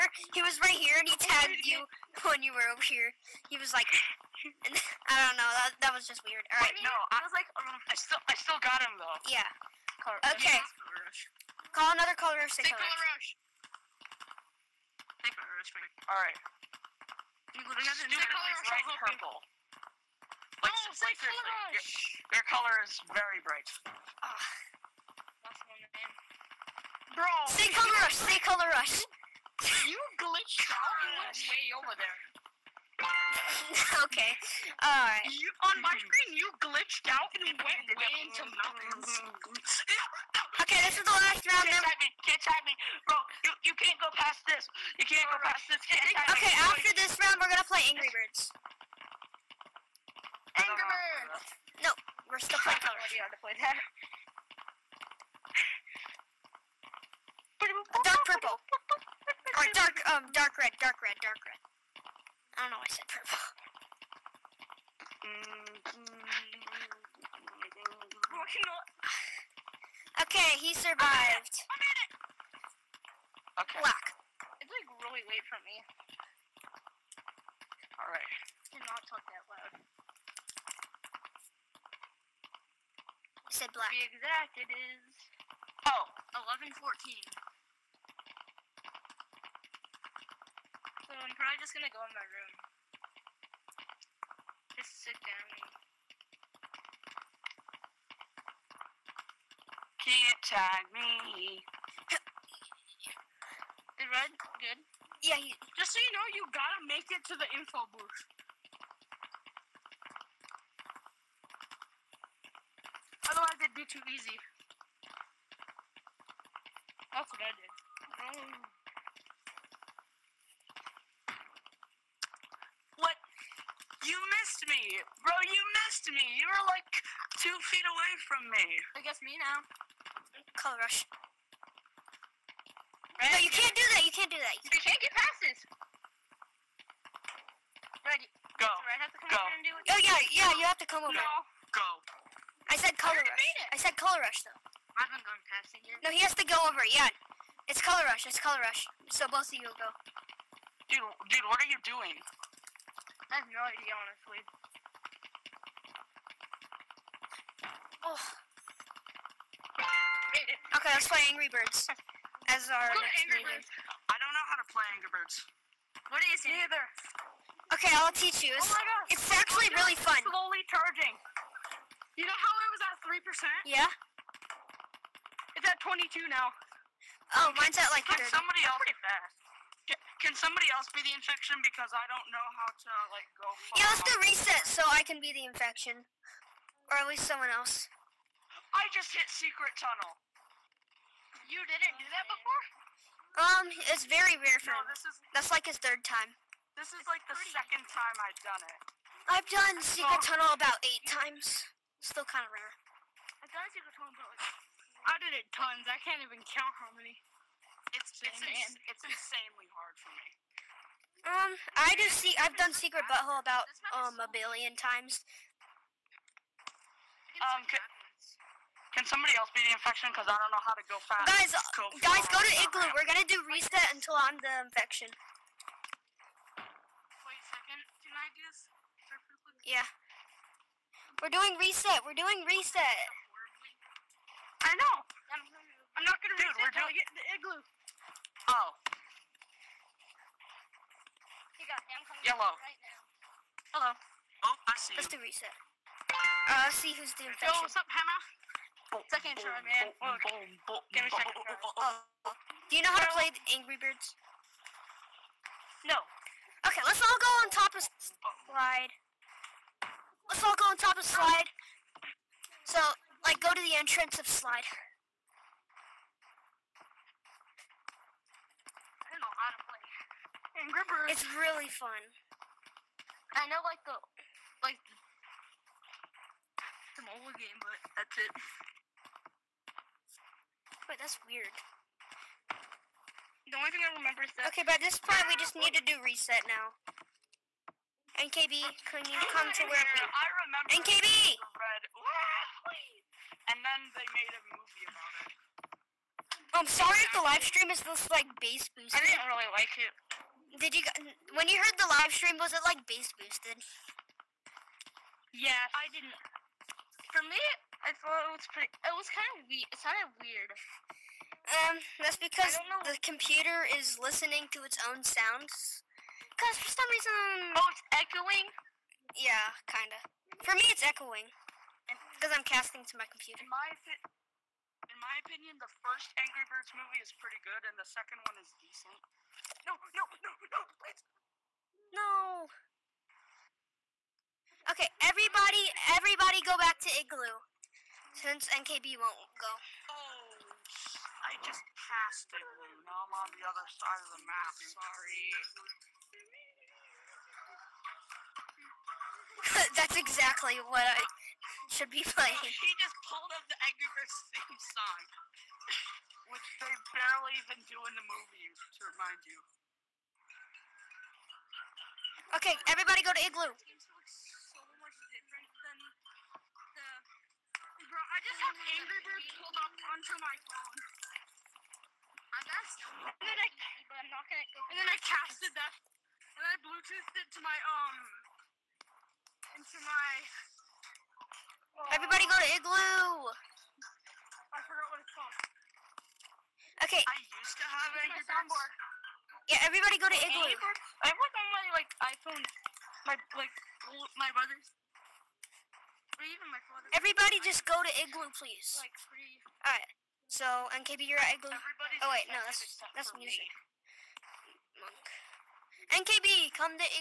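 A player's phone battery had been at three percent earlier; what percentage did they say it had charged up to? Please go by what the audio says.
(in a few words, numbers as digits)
22 percent.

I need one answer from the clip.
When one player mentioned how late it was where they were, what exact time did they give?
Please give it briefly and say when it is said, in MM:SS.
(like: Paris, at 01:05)
11:14, at 01:26.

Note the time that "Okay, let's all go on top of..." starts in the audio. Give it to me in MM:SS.
04:16.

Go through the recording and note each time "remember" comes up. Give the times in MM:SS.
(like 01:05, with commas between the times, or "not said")
04:43, 04:50.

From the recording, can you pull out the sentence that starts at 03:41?
Guys, go guys, go to Igloo.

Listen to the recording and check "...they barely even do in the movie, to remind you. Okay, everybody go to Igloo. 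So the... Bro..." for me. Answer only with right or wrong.
right.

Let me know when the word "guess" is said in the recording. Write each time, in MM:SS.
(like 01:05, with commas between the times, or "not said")
02:09.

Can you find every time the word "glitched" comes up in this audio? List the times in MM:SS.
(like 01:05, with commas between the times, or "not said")
00:30, 00:36.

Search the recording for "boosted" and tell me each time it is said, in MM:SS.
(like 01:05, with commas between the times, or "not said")
04:58, 05:03.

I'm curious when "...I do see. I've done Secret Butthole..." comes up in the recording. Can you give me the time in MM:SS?
03:31.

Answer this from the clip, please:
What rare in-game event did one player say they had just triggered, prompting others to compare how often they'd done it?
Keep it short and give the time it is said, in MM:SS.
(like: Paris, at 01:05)
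Secret tunnel, at 03:09.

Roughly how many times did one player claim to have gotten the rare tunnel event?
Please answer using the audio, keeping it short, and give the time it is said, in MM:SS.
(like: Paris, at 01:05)
About 8 times, at 03:20.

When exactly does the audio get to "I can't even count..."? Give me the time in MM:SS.
03:25.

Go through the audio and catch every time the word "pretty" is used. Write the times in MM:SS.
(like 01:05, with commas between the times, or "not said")
02:58, 05:08, 05:27.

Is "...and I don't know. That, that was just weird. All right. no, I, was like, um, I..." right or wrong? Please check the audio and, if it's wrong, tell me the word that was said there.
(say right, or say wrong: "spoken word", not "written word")
right.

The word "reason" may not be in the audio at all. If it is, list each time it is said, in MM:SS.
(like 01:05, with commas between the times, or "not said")
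05:16.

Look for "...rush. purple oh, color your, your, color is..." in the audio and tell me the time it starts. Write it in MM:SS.
00:18.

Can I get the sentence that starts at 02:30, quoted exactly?
Dude, dude, what are you doing?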